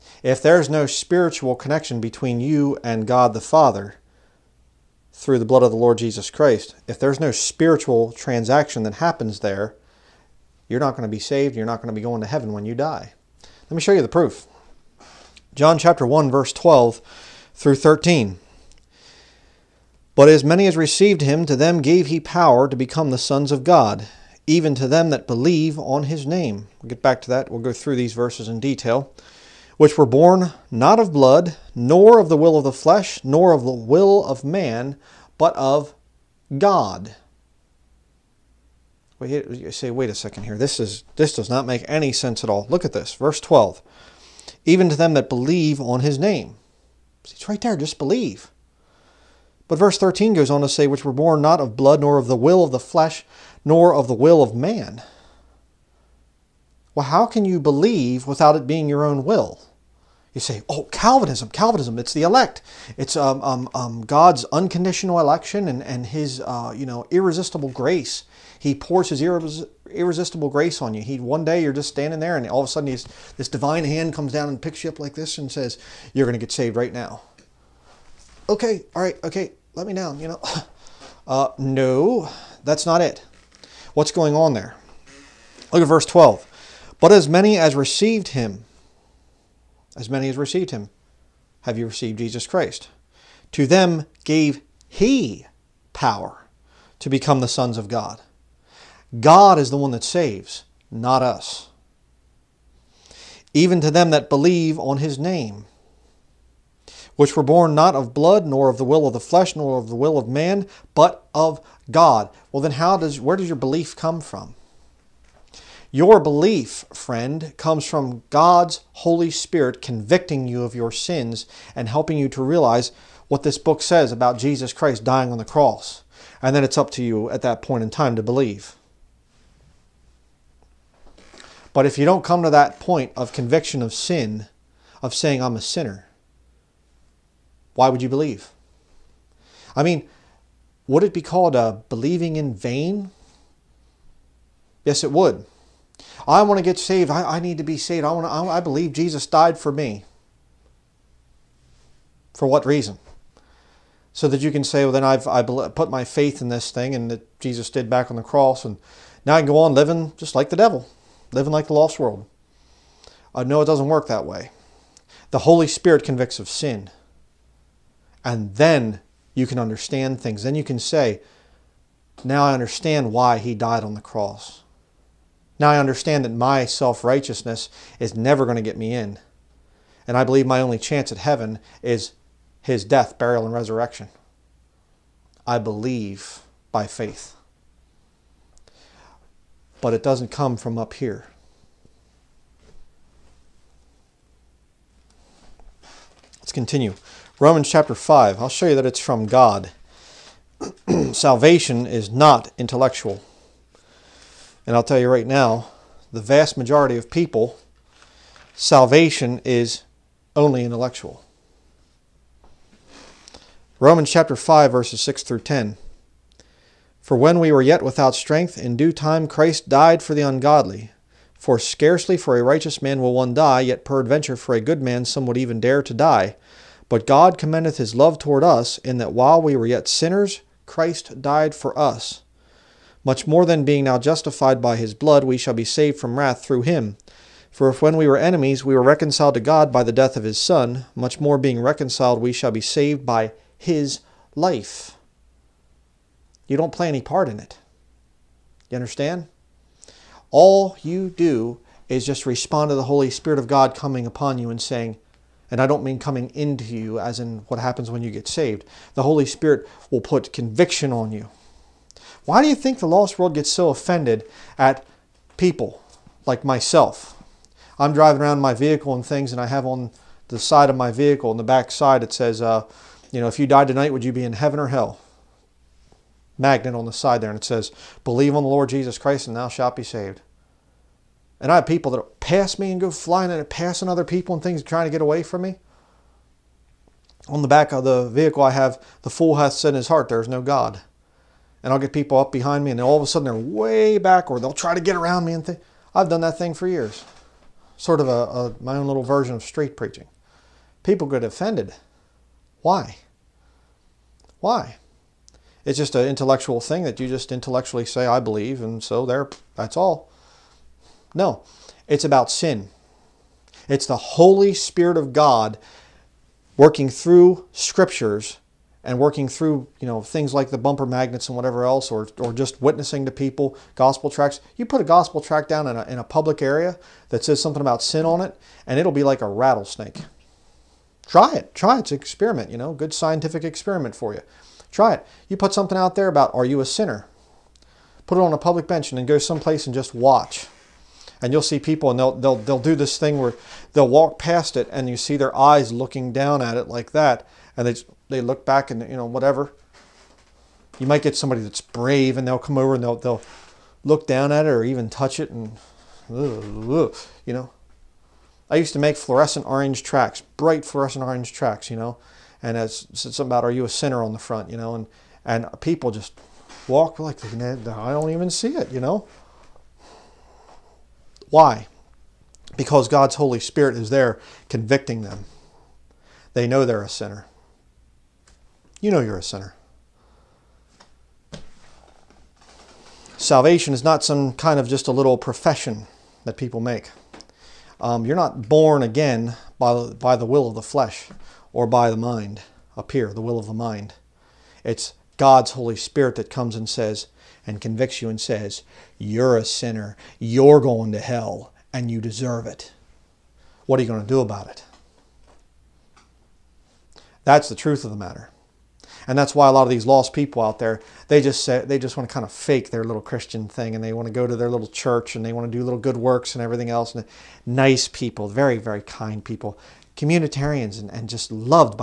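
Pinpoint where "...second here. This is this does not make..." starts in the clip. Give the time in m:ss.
0:40.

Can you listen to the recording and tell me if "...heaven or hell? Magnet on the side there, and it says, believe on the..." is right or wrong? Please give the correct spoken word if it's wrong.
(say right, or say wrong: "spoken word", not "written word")
right.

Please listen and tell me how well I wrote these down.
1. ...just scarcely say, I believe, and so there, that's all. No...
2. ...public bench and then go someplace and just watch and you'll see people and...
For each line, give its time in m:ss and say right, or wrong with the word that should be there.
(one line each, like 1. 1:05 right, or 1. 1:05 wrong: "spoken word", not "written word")
1. 5:07 wrong: "intellectually", not "scarcely"
2. 5:38 right.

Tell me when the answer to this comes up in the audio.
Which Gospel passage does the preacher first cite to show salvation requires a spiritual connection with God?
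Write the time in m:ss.
0:15.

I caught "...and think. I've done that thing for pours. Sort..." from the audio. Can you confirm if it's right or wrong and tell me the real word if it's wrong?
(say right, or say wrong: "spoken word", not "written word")
wrong: "years", not "pours".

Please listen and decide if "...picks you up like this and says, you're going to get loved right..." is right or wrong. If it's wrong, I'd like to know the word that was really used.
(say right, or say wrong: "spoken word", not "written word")
wrong: "saved", not "loved".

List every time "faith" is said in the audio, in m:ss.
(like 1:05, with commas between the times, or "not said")
2:36, 3:06.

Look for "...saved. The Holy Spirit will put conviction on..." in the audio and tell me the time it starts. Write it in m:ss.
4:18.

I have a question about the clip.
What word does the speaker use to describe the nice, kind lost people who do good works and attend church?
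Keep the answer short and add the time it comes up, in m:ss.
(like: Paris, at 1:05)
Communitarians, at 6:59.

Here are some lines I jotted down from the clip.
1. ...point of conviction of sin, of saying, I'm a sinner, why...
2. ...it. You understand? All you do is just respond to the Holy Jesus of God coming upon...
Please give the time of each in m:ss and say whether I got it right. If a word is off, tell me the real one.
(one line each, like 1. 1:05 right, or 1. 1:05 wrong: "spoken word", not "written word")
1. 2:12 right
2. 4:07 wrong: "Spirit", not "Jesus".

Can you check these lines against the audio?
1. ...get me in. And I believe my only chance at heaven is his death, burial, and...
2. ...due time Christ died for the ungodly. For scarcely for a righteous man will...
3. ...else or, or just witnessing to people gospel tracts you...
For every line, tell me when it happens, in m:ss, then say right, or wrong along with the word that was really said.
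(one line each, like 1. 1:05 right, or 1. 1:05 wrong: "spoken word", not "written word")
1. 2:58 right
2. 3:38 right
3. 5:21 right.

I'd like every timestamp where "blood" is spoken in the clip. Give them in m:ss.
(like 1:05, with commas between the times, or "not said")
0:05, 0:31, 0:51, 1:48, 3:54.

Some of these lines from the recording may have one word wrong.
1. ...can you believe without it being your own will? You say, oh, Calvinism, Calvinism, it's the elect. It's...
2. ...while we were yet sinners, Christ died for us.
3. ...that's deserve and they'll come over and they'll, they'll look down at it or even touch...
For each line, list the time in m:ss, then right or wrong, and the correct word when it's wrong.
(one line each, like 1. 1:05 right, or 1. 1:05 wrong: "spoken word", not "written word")
1. 0:57 right
2. 3:49 right
3. 5:51 wrong: "brave", not "deserve".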